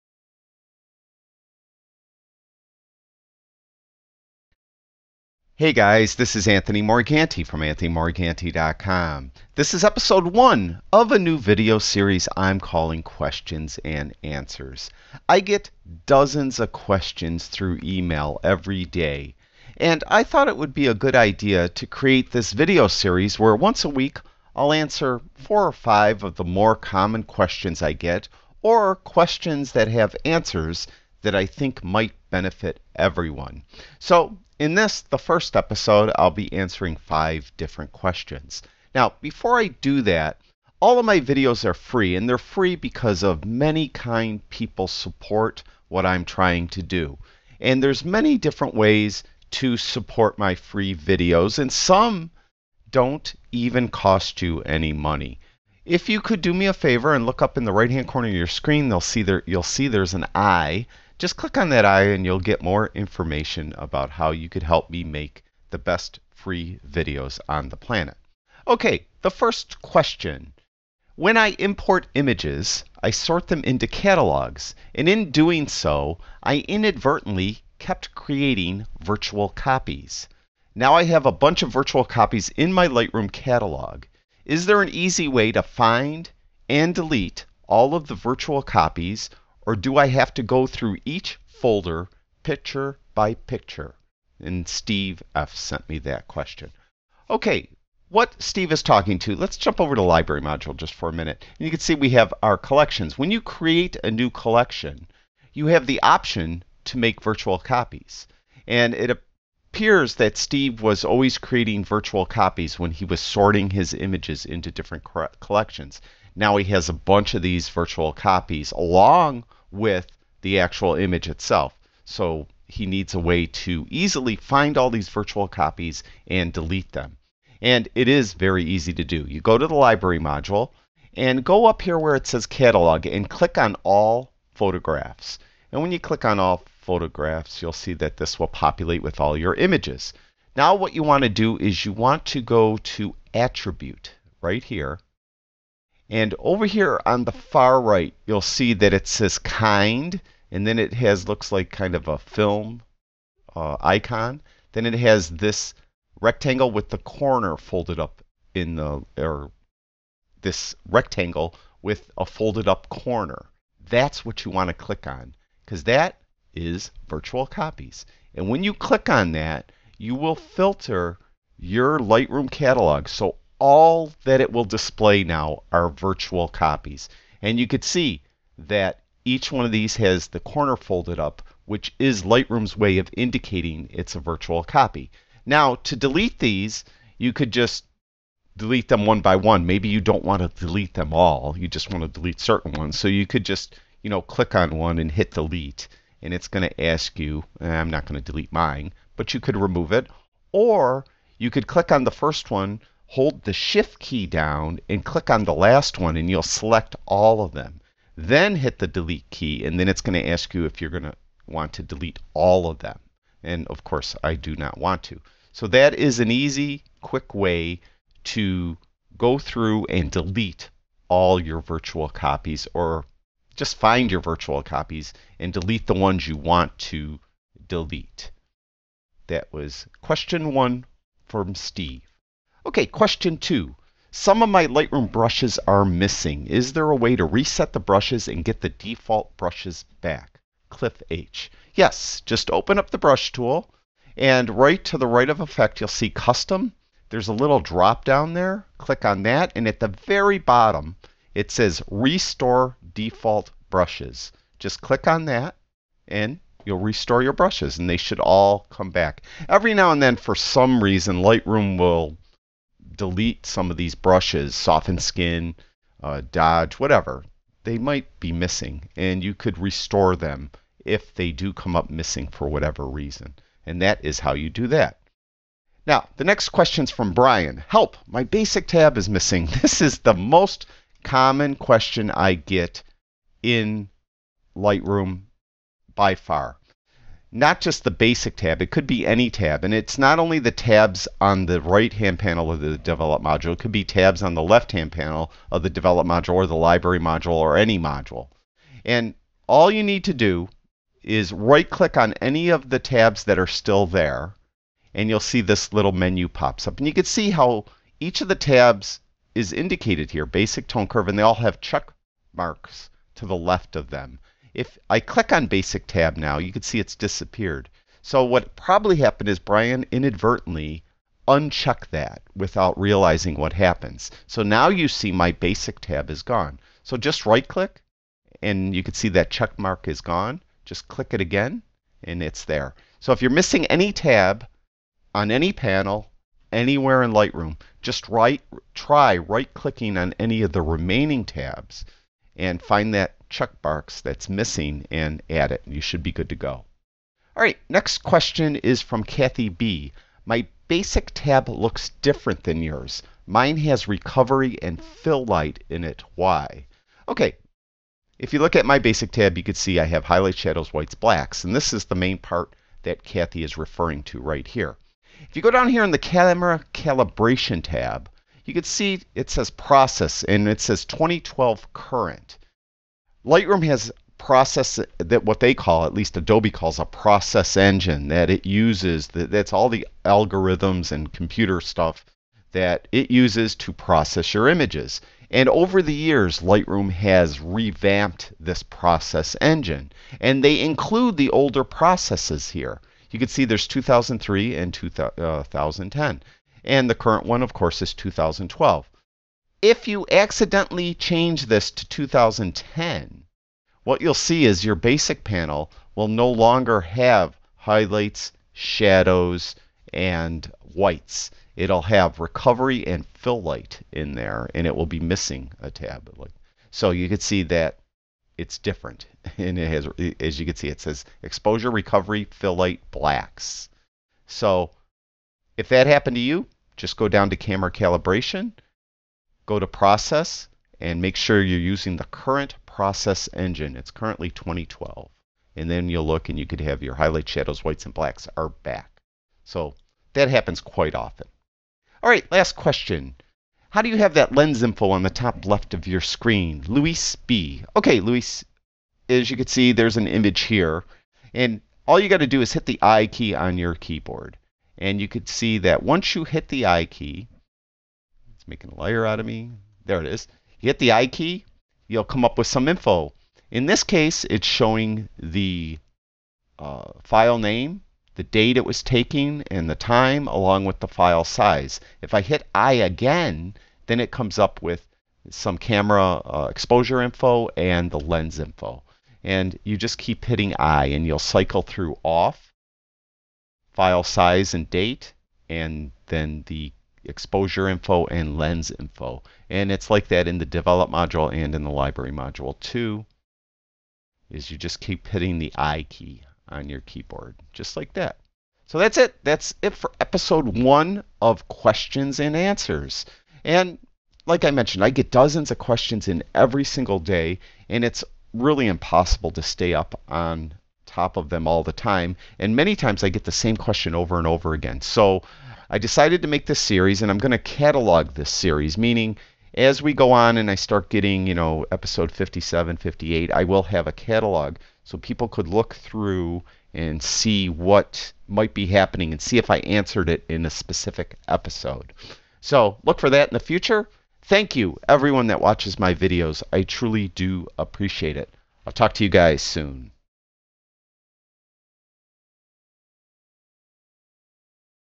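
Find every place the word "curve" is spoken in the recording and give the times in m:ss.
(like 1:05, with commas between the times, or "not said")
5:10.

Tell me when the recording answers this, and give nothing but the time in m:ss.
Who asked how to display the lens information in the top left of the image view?
7:26.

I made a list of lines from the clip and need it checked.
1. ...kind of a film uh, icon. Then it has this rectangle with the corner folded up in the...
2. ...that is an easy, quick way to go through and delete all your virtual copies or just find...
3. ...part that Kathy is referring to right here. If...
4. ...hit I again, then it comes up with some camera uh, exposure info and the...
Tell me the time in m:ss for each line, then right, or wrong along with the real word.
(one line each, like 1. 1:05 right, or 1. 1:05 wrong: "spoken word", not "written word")
1. 2:31 right
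2. 3:35 right
3. 6:02 right
4. 7:52 right.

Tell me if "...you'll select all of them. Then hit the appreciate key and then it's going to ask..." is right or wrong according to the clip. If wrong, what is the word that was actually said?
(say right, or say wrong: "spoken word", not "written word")
wrong: "delete", not "appreciate".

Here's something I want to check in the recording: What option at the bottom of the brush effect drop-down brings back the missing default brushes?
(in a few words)
restore default brushes.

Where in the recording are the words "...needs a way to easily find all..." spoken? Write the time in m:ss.
2:02.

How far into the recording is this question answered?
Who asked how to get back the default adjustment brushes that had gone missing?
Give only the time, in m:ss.
4:00.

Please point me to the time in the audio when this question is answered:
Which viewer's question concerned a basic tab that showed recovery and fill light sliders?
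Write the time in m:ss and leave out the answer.
5:49.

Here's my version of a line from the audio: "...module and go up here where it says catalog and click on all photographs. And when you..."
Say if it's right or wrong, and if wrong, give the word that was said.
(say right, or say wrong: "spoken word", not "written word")
right.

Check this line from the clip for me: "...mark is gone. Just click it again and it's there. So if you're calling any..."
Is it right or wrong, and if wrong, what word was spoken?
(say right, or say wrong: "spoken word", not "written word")
wrong: "missing", not "calling".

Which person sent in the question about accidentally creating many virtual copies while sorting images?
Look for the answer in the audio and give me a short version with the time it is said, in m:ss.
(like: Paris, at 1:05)
Steve F., at 1:34.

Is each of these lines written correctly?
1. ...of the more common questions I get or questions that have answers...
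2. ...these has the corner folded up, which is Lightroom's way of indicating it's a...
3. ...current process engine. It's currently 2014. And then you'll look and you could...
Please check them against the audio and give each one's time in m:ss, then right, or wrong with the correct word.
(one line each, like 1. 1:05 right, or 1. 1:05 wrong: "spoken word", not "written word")
1. 0:26 right
2. 2:59 right
3. 7:12 wrong: "2012", not "2014".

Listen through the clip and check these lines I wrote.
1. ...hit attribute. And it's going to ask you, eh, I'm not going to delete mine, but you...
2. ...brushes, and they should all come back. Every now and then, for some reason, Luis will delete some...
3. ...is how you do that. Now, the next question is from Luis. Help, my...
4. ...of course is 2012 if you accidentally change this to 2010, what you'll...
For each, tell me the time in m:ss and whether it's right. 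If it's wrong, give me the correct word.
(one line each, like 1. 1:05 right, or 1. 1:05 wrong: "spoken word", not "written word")
1. 3:15 wrong: "delete", not "attribute"
2. 4:17 wrong: "Lightroom", not "Luis"
3. 4:34 wrong: "Brian", not "Luis"
4. 6:37 right.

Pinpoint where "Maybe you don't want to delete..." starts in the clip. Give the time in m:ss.
3:09.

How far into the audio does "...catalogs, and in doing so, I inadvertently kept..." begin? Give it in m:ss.
1:13.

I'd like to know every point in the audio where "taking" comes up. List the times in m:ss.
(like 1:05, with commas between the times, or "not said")
7:48.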